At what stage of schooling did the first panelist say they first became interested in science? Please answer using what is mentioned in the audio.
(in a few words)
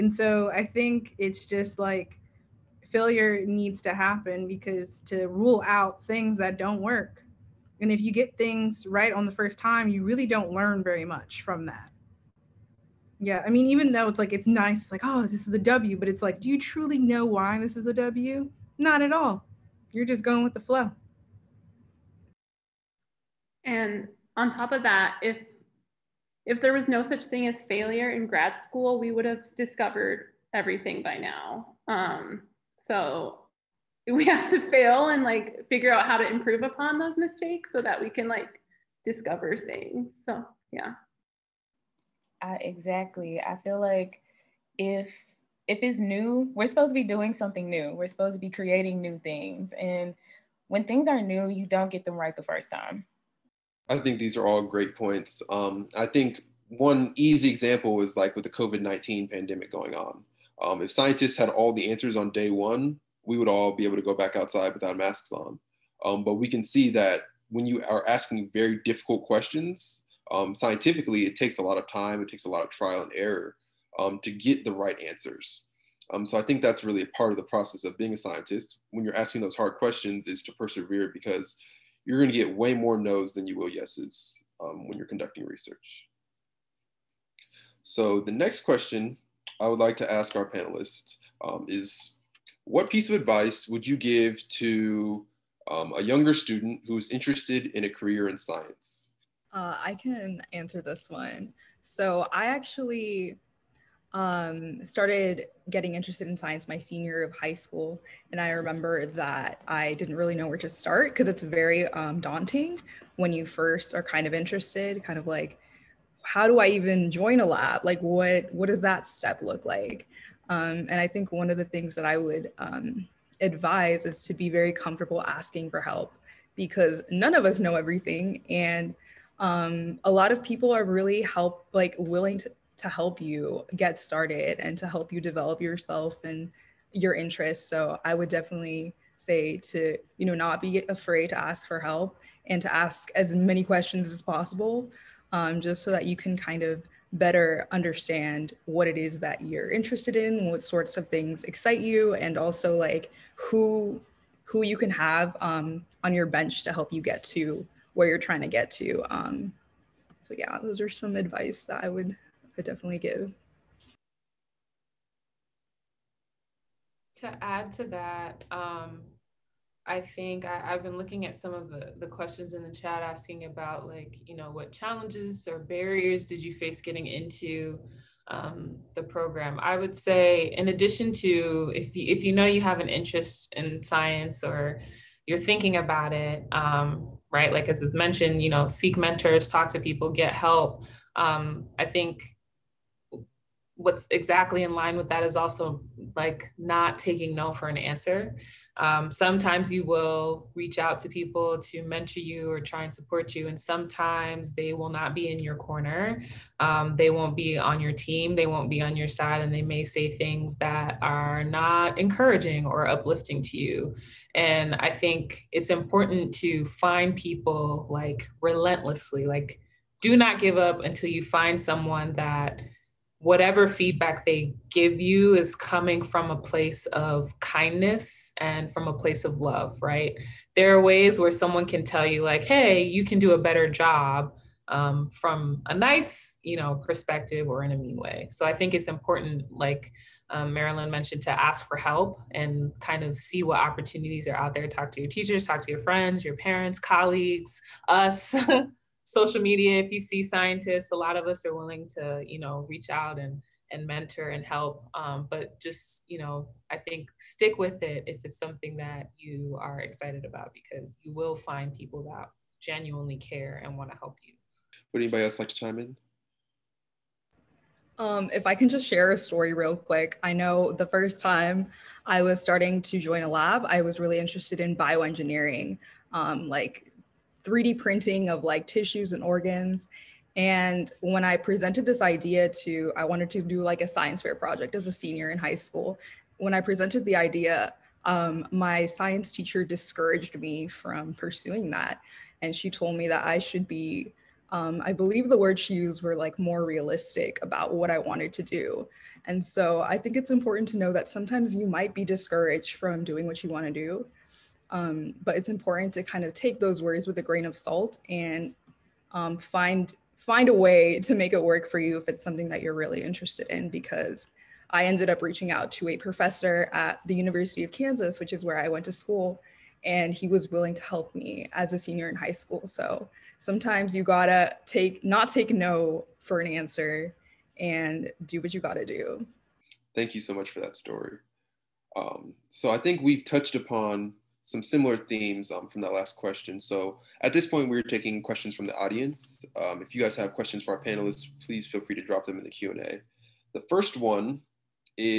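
Senior year of high school.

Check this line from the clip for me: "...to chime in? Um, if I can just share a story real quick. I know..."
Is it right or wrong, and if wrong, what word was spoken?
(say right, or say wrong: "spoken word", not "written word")
right.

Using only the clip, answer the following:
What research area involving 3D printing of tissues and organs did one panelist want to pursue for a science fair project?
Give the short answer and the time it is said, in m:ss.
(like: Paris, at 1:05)
Bioengineering, at 4:34.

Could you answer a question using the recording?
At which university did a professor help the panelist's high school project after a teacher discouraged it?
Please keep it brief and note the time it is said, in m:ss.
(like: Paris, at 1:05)
University of Kansas, at 5:17.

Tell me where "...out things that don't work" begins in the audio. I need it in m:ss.
0:05.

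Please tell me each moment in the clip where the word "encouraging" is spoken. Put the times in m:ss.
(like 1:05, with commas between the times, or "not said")
3:31.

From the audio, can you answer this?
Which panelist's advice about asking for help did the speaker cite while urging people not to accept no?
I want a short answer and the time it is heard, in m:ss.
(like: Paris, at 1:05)
Marilyn, at 4:00.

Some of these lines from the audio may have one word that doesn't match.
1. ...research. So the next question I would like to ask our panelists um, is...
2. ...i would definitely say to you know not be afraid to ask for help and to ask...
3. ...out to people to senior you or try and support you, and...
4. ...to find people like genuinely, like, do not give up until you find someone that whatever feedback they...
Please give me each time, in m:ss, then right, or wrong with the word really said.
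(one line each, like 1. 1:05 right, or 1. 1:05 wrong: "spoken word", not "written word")
1. 1:25 right
2. 2:18 right
3. 3:20 wrong: "mentor", not "senior"
4. 3:36 wrong: "relentlessly", not "genuinely".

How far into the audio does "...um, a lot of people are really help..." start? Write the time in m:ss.
2:09.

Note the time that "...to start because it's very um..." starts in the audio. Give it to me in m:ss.
1:50.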